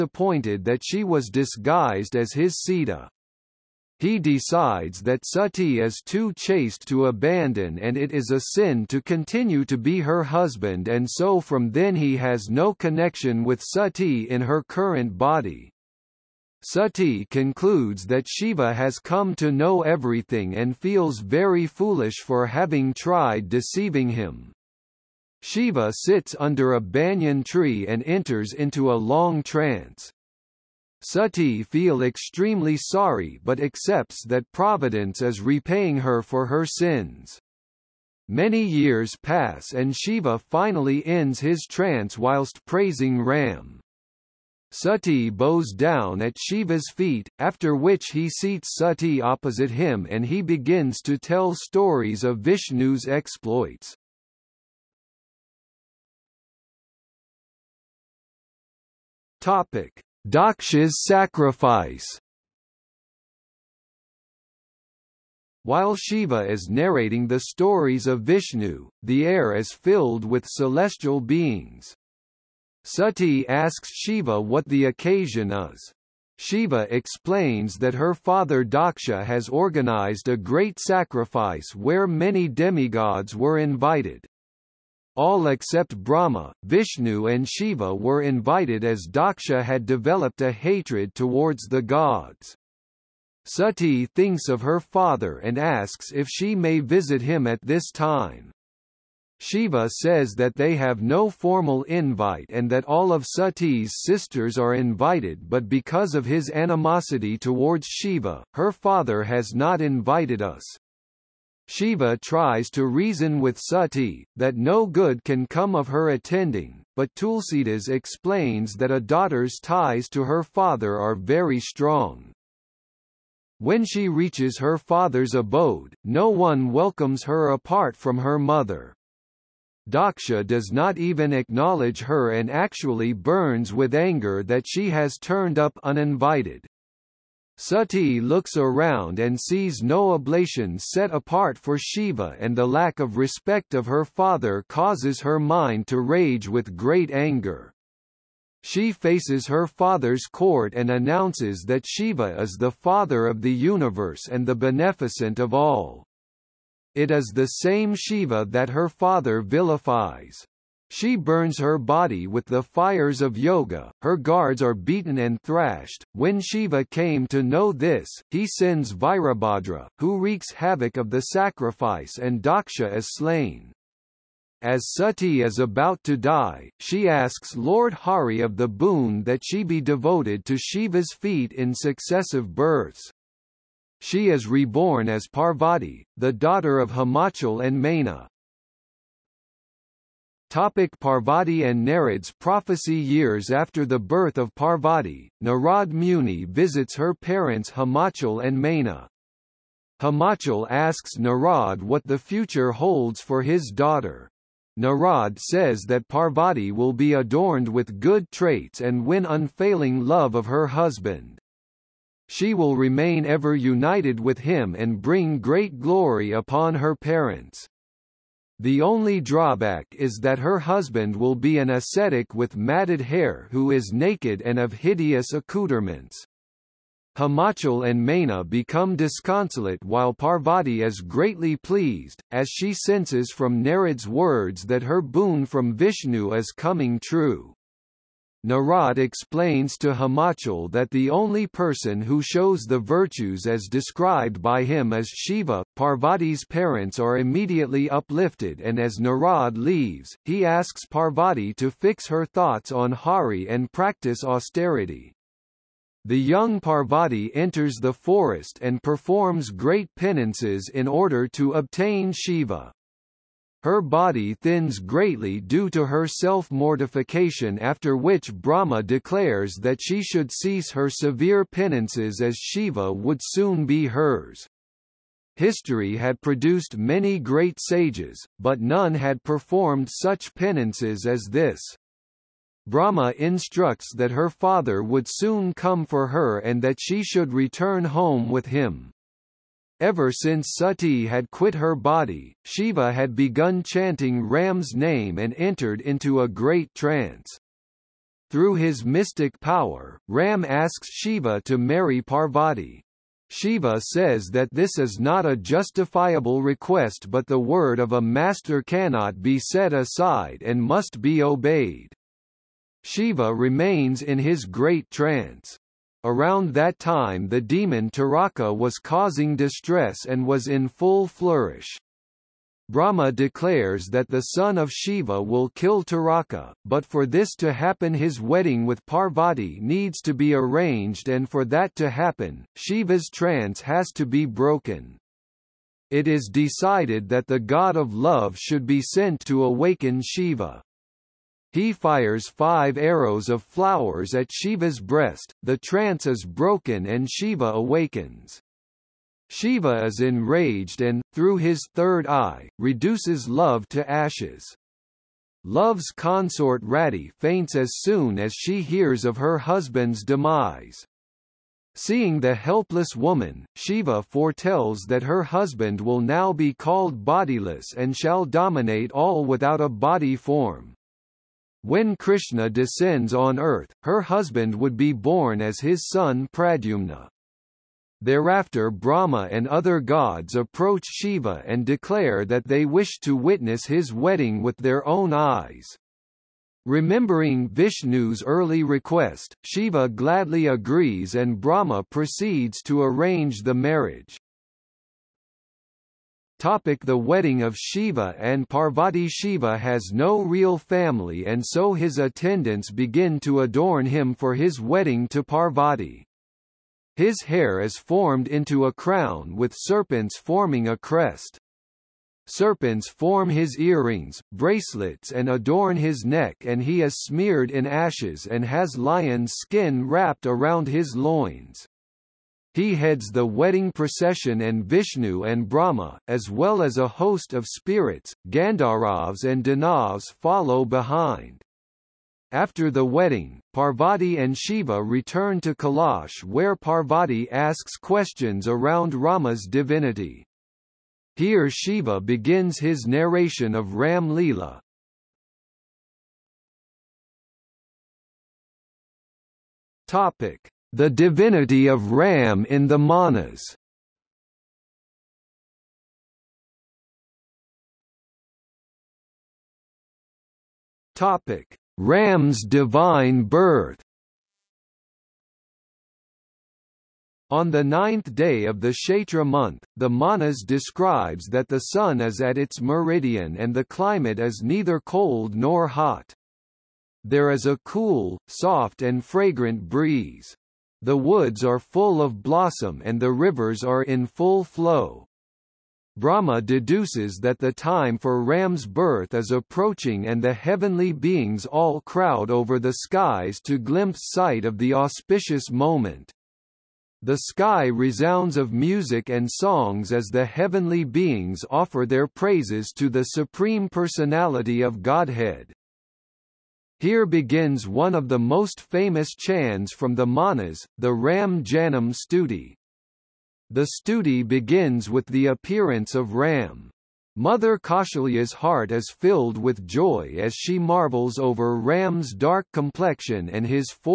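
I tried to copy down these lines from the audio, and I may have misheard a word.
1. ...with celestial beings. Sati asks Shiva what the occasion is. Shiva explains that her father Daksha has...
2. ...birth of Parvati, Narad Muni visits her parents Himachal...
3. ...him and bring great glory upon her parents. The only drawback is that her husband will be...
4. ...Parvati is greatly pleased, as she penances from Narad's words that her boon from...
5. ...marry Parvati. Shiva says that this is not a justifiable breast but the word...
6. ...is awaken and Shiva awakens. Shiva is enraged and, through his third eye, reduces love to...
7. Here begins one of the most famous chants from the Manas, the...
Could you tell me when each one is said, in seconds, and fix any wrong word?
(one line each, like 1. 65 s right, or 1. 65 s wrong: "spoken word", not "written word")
1. 70 s right
2. 193 s right
3. 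214 s right
4. 230 s wrong: "senses", not "penances"
5. 301 s wrong: "request", not "breast"
6. 346 s wrong: "broken", not "awaken"
7. 506 s right.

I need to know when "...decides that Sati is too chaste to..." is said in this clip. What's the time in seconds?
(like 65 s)
4 s.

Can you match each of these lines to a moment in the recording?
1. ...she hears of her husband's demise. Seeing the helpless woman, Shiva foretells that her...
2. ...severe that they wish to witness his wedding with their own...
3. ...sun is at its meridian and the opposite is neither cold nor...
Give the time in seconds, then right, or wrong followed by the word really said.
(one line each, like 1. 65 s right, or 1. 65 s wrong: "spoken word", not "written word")
1. 358 s right
2. 381 s wrong: "declare", not "severe"
3. 471 s wrong: "climate", not "opposite".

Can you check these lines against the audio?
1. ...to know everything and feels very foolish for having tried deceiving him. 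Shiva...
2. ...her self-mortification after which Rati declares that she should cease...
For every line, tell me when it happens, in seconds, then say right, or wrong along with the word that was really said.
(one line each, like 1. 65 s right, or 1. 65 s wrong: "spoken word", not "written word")
1. 19 s right
2. 265 s wrong: "Brahma", not "Rati".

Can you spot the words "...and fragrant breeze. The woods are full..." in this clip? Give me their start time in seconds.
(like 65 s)
478 s.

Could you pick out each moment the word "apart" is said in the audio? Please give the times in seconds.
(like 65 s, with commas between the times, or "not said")
127 s, 141 s.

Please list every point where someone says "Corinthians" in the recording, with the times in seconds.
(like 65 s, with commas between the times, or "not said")
not said.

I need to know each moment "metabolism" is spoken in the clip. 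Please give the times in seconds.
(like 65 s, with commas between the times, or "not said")
not said.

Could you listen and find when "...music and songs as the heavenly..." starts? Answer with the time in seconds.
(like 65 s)
498 s.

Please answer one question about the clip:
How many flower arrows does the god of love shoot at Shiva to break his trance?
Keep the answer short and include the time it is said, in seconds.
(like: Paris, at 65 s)
5, at 342 s.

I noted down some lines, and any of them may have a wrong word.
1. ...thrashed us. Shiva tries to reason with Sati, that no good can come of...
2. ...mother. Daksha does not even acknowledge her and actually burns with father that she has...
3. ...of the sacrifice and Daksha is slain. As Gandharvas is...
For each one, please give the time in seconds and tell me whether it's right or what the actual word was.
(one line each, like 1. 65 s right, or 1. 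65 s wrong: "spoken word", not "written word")
1. 109 s wrong: "invited", not "thrashed"
2. 128 s wrong: "anger", not "father"
3. 170 s wrong: "Sati", not "Gandharvas".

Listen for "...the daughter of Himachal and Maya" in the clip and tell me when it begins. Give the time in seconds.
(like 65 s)
186 s.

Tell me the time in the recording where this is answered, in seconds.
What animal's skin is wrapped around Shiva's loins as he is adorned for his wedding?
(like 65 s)
418 s.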